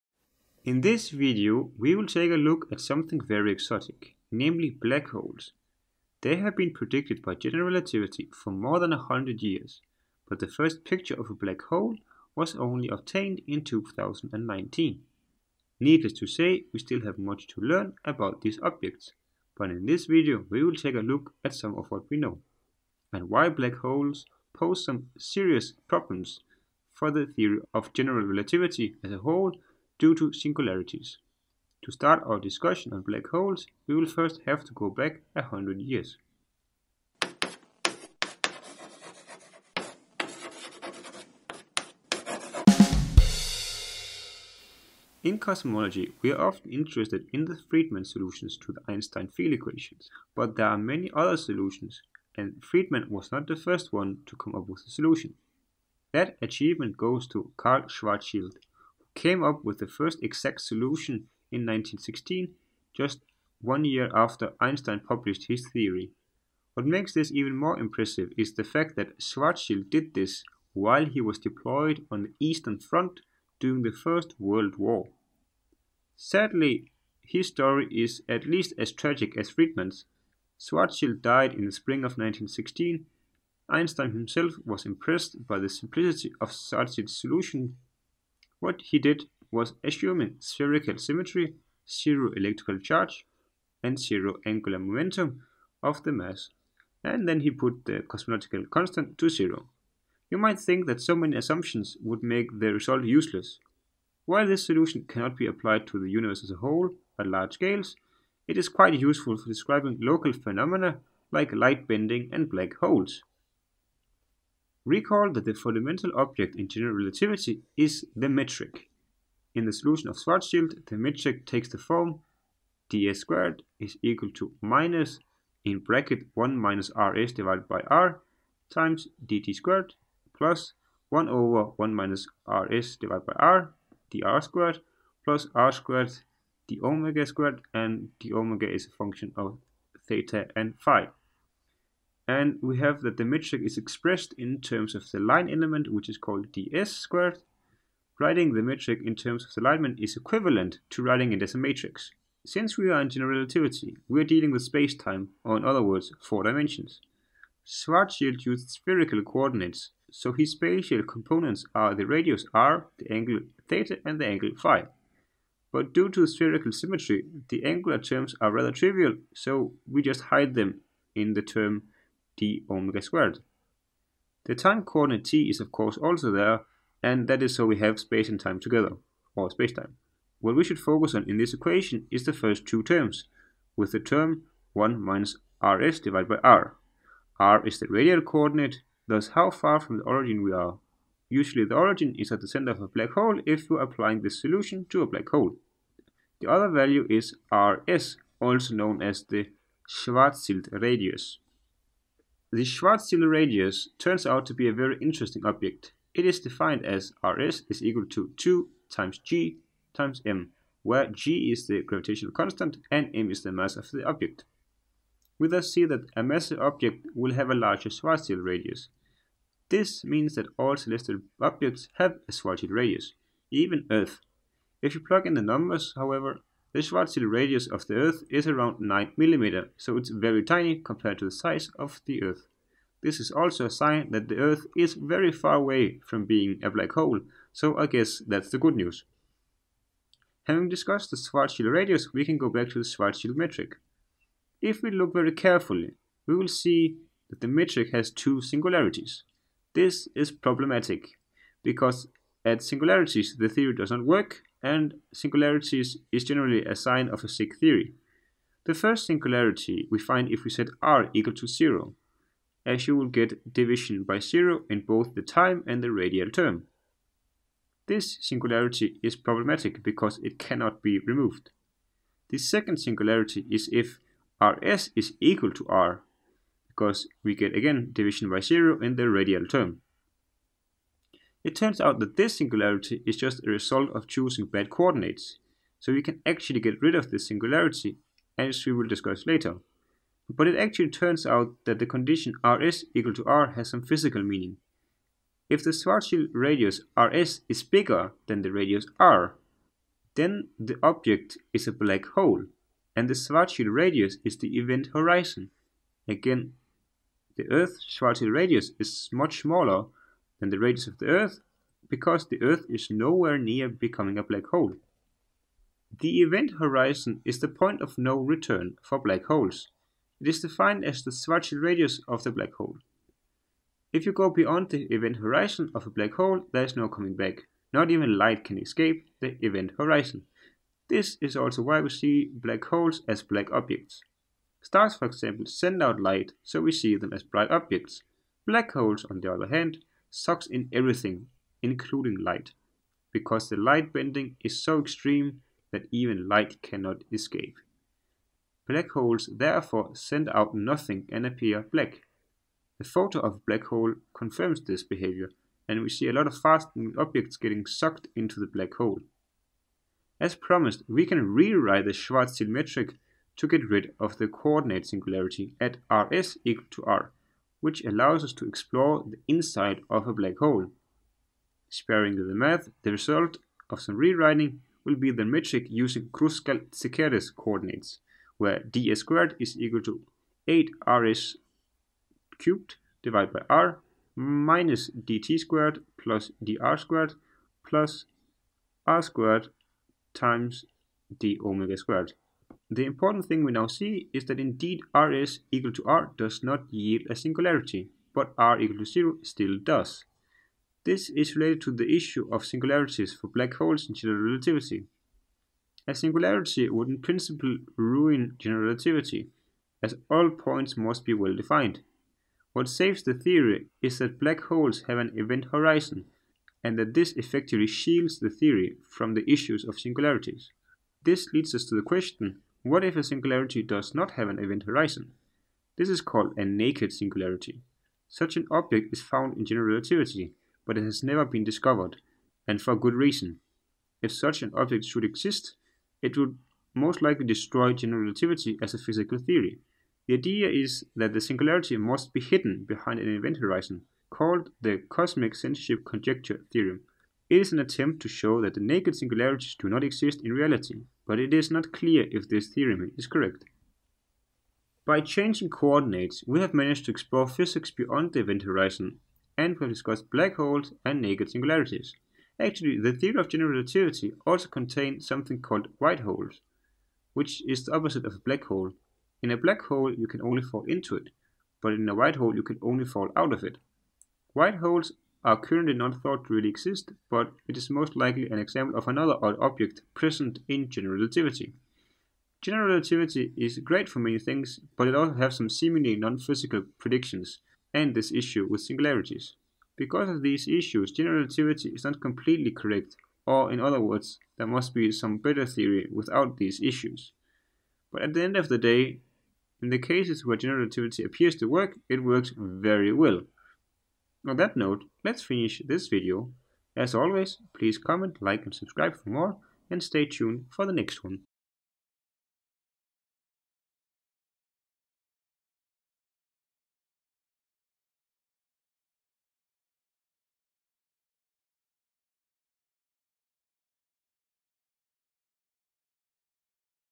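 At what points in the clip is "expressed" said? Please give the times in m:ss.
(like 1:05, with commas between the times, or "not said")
2:23.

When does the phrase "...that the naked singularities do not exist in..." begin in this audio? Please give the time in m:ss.
7:28.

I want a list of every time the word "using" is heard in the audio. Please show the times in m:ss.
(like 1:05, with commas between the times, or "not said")
6:15.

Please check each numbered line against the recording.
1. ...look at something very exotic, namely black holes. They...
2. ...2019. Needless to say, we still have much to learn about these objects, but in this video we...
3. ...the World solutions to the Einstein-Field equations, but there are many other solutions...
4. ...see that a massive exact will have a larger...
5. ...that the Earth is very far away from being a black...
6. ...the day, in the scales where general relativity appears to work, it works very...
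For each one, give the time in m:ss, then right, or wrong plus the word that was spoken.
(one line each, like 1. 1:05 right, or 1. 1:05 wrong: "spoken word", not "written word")
1. 0:02 right
2. 0:13 right
3. 0:47 wrong: "Friedmann", not "World"
4. 3:35 wrong: "object", not "exact"
5. 3:54 right
6. 8:18 wrong: "cases", not "scales".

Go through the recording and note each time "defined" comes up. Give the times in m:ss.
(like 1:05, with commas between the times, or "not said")
3:26, 5:20, 6:51.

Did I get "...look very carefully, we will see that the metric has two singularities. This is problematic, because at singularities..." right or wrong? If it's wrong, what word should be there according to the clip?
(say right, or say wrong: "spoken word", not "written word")
right.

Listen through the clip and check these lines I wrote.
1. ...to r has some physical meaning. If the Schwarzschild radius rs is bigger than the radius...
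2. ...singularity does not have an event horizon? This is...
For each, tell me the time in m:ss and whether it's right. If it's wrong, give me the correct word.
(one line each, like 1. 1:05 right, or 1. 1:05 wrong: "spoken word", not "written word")
1. 4:53 right
2. 7:03 right.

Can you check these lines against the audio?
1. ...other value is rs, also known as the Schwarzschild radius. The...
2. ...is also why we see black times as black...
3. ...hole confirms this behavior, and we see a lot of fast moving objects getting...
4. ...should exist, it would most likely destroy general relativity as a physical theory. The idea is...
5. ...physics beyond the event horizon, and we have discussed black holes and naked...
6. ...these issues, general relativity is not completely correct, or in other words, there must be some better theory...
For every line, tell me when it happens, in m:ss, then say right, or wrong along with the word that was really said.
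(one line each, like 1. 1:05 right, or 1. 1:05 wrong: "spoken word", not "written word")
1. 3:16 right
2. 5:31 wrong: "holes", not "times"
3. 5:53 right
4. 7:14 right
5. 7:37 right
6. 8:10 right.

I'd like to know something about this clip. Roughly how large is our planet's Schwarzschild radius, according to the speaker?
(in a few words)
9 mm.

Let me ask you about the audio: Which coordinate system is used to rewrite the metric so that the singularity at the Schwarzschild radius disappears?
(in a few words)
Kruskal-Szekeres coordinates.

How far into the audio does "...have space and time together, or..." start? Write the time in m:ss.
2:57.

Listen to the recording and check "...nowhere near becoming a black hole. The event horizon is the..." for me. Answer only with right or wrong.
right.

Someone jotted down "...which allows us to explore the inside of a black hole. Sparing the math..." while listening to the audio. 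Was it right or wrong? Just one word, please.
right.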